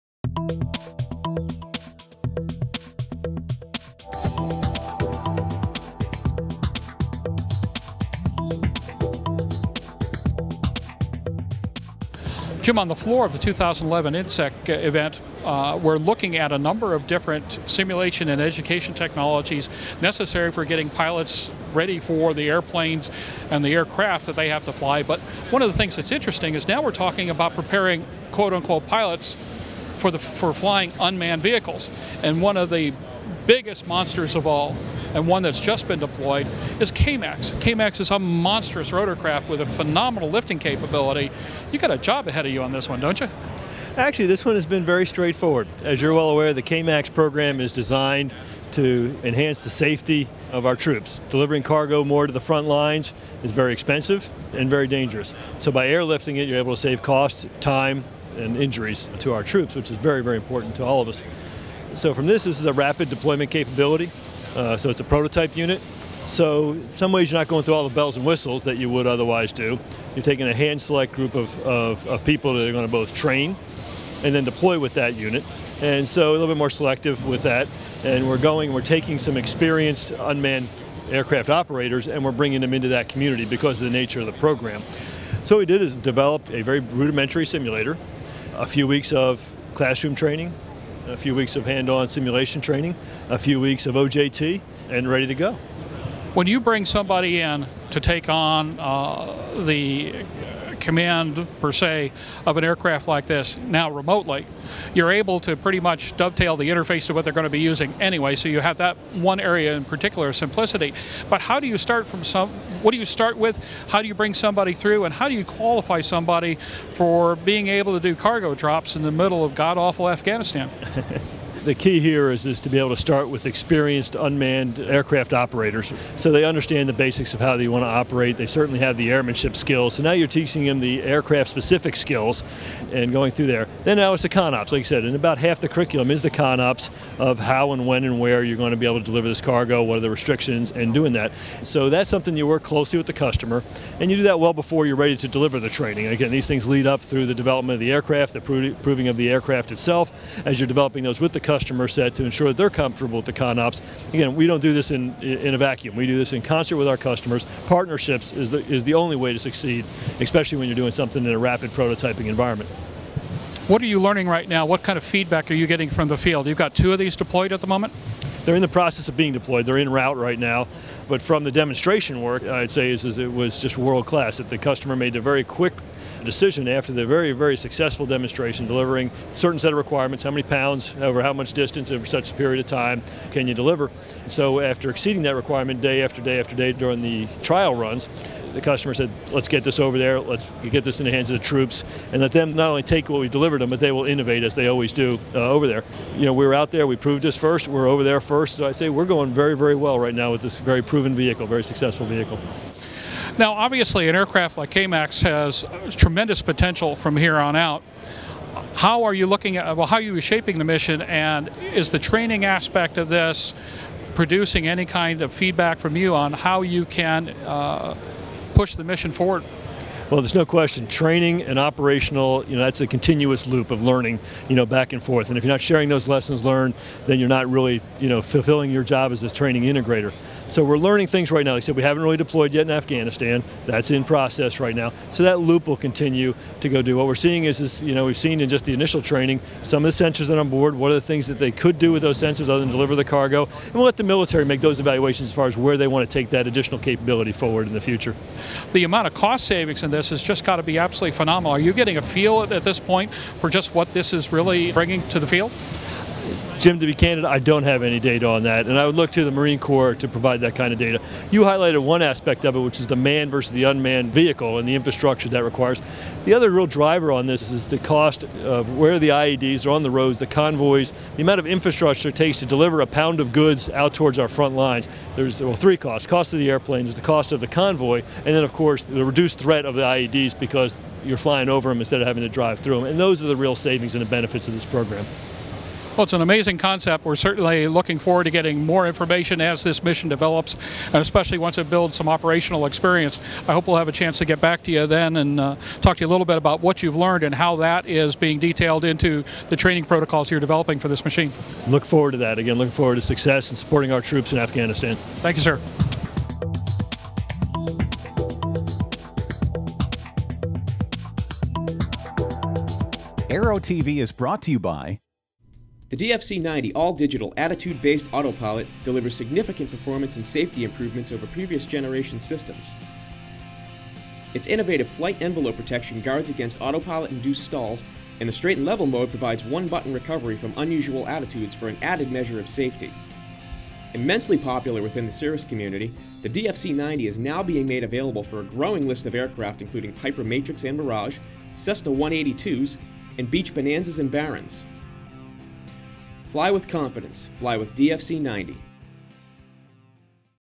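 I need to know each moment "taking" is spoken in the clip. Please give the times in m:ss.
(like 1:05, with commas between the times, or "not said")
1:10, 1:18.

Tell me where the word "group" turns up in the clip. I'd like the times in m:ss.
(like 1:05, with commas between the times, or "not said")
1:11.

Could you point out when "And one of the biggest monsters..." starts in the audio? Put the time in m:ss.
0:32.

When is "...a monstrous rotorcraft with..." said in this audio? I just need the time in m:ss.
0:38.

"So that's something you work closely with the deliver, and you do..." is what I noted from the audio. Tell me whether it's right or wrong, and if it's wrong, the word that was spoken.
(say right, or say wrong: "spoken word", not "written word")
wrong: "customer", not "deliver".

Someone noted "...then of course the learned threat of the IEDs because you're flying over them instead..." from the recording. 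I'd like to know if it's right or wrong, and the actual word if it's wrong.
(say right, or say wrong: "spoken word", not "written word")
wrong: "reduced", not "learned".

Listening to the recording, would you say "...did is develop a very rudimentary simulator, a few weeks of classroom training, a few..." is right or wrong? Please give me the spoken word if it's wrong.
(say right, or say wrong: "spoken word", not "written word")
right.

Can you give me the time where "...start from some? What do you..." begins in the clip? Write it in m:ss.
1:51.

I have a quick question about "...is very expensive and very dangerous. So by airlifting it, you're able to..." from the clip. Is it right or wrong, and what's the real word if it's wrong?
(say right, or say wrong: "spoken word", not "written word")
right.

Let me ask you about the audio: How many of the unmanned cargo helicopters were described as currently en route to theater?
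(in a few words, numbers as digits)
2.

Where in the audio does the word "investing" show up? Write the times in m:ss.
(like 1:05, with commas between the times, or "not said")
not said.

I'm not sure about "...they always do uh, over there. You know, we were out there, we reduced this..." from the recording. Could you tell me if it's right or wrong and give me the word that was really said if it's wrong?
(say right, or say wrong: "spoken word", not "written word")
wrong: "proved", not "reduced".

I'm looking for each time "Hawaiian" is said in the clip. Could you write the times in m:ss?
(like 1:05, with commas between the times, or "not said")
not said.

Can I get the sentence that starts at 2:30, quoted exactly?
As you're developing those with the customer set to ensure that they're comfortable with the ConOps.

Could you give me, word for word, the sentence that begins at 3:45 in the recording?
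And if you're not sharing those lessons learned, then you're not really, you know, fulfilling your job as this training integrator.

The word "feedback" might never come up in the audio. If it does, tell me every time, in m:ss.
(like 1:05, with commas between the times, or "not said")
2:45, 3:35.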